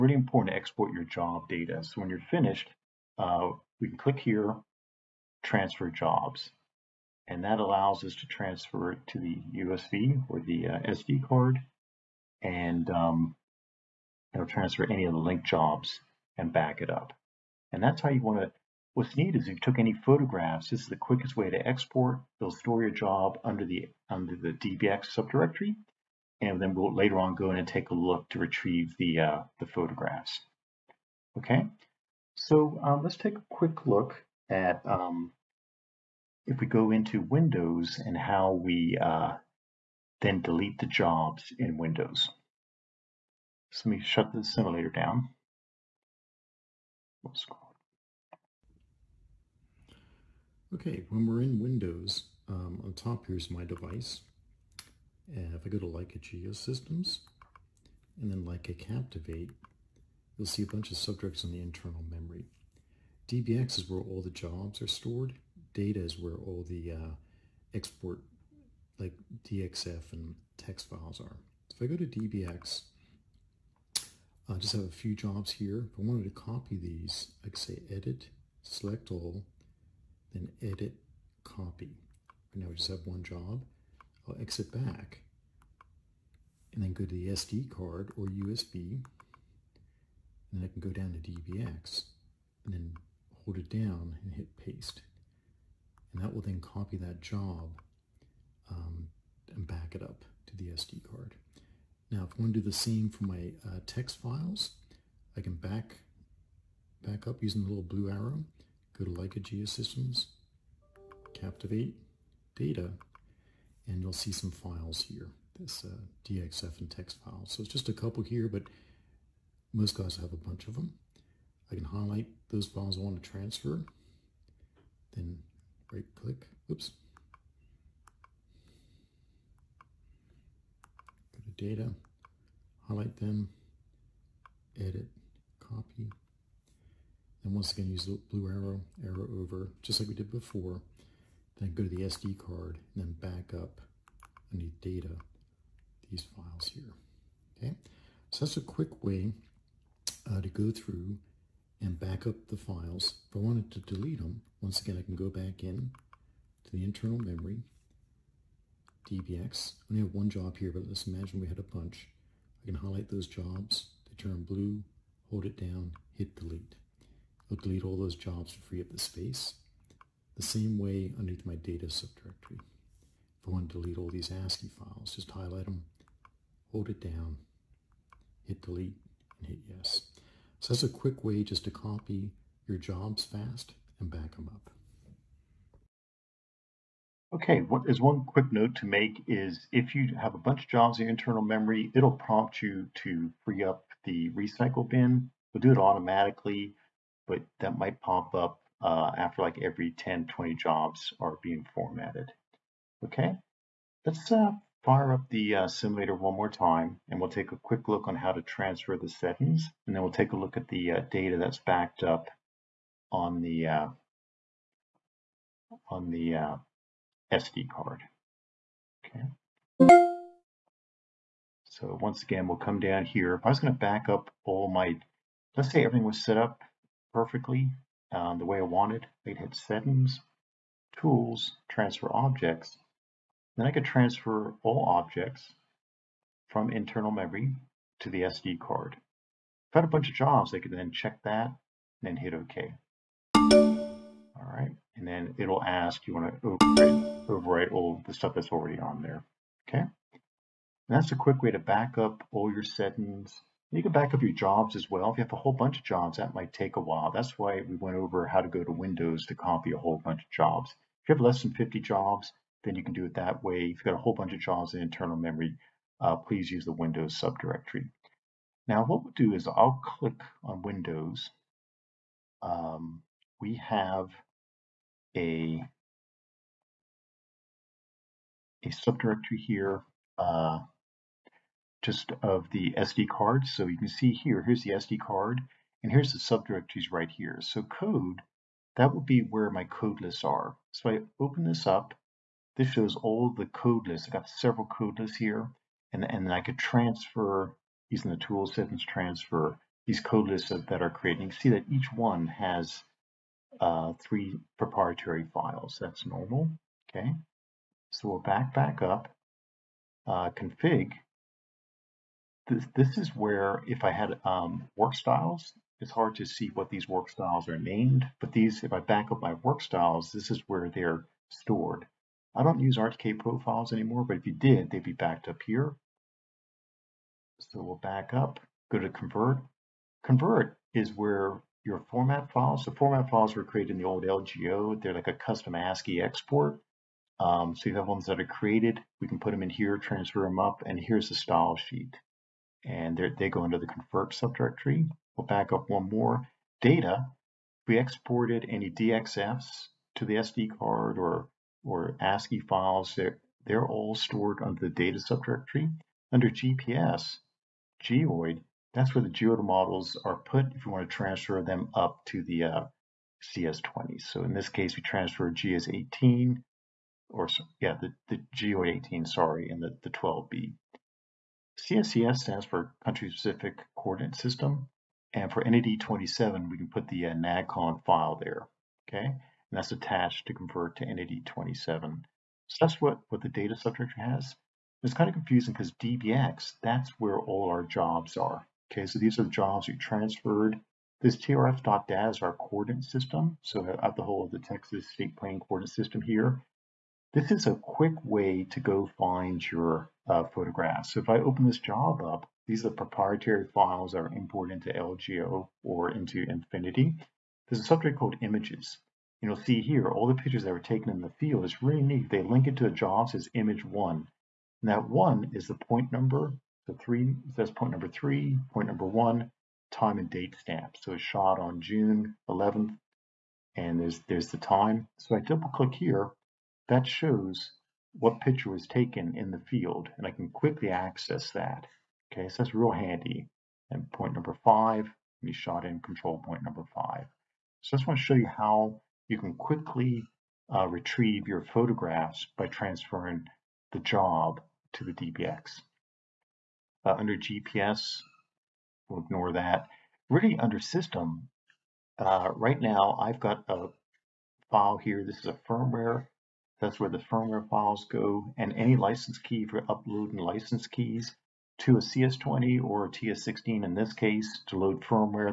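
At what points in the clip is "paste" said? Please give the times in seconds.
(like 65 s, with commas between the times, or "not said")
94 s.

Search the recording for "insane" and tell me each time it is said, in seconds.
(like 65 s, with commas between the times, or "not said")
not said.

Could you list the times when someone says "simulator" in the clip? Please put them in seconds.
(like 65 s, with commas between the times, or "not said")
44 s, 205 s.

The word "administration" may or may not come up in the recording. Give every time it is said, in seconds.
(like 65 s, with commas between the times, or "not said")
not said.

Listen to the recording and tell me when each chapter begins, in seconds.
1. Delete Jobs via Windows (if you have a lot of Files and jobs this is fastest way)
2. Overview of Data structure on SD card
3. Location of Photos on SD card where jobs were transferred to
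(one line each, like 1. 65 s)
1. 152 s
2. 277 s
3. 392 s.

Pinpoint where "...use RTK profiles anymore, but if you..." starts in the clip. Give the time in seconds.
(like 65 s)
322 s.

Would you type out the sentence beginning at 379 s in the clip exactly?
And that's attached to convert to NAD 27.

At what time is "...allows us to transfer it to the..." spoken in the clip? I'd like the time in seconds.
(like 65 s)
7 s.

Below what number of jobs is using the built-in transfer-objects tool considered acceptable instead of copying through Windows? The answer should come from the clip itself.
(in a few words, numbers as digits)
50.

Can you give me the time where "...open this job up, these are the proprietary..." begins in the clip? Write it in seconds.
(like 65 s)
401 s.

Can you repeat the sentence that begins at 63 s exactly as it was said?
DBX is where all the jobs are stored.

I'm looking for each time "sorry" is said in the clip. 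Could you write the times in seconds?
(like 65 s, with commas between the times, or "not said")
369 s.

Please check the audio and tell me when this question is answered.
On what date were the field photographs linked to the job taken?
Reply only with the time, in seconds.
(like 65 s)
421 s.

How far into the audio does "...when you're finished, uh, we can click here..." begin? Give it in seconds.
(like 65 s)
2 s.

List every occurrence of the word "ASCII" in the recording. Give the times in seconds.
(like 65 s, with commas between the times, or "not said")
174 s, 335 s, 352 s.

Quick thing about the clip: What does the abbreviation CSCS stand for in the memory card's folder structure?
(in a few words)
Country-Specific Coordinate System.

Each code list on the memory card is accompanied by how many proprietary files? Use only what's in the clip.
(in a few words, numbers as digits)
3.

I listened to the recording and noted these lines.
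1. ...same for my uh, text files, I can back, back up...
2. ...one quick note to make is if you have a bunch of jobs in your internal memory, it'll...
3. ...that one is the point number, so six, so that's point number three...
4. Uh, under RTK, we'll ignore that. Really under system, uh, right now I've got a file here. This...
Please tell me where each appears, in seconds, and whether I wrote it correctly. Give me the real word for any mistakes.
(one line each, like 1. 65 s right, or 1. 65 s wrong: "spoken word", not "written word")
1. 102 s right
2. 187 s right
3. 414 s wrong: "three", not "six"
4. 446 s wrong: "GPS", not "RTK".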